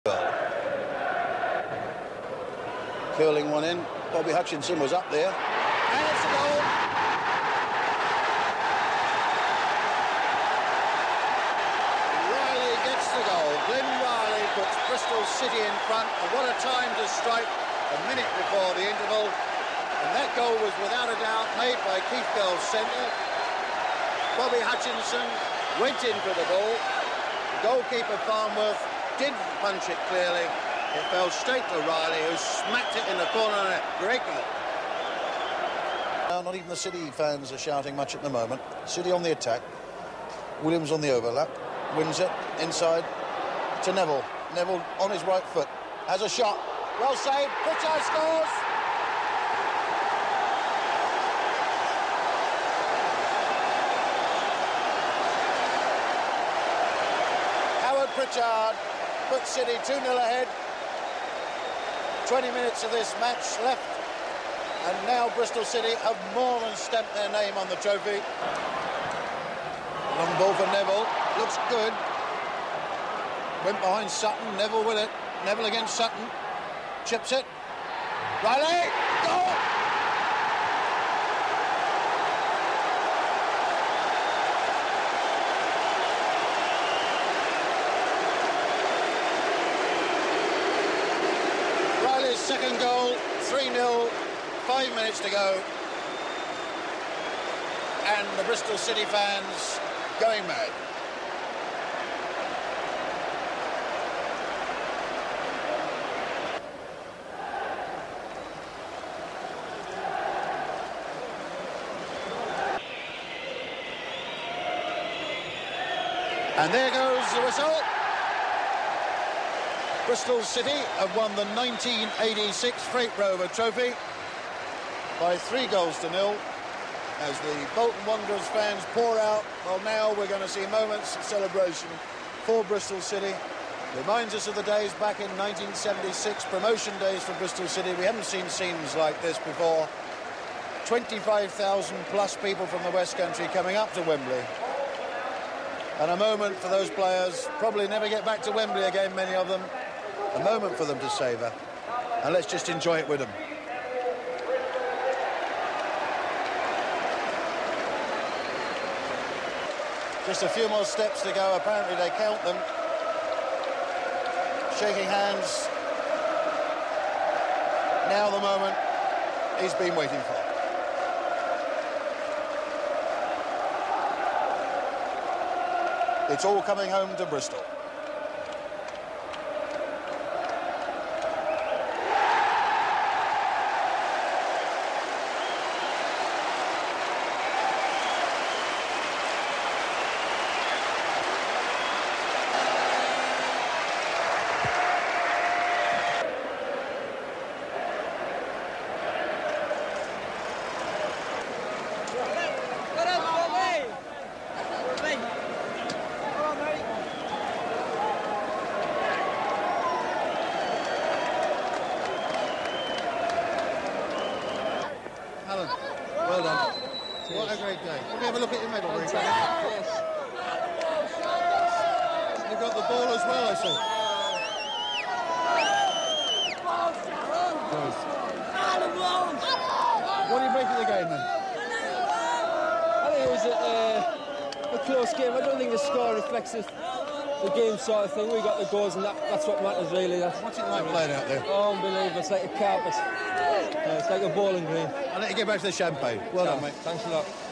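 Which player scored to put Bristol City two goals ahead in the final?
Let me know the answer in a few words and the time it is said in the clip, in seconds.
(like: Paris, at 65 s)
Howard Pritchard, at 57 s.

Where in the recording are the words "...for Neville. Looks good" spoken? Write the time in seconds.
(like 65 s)
70 s.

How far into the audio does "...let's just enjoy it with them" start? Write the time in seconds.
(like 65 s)
152 s.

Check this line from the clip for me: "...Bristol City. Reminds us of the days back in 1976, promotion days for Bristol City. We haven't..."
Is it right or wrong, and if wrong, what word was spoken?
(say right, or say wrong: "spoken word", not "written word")
right.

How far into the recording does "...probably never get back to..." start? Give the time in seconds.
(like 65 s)
147 s.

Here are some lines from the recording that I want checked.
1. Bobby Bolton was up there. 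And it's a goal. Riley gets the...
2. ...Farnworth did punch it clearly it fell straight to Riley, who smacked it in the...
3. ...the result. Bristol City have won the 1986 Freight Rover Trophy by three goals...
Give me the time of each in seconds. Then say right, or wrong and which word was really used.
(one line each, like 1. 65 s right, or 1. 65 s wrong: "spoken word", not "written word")
1. 4 s wrong: "Hutchinson", not "Bolton"
2. 28 s right
3. 117 s right.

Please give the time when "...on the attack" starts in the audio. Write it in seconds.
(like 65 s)
39 s.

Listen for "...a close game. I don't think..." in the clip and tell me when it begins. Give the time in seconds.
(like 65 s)
234 s.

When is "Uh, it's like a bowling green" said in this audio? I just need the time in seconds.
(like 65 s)
242 s.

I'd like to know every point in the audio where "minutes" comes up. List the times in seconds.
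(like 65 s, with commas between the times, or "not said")
18 s, 62 s, 94 s.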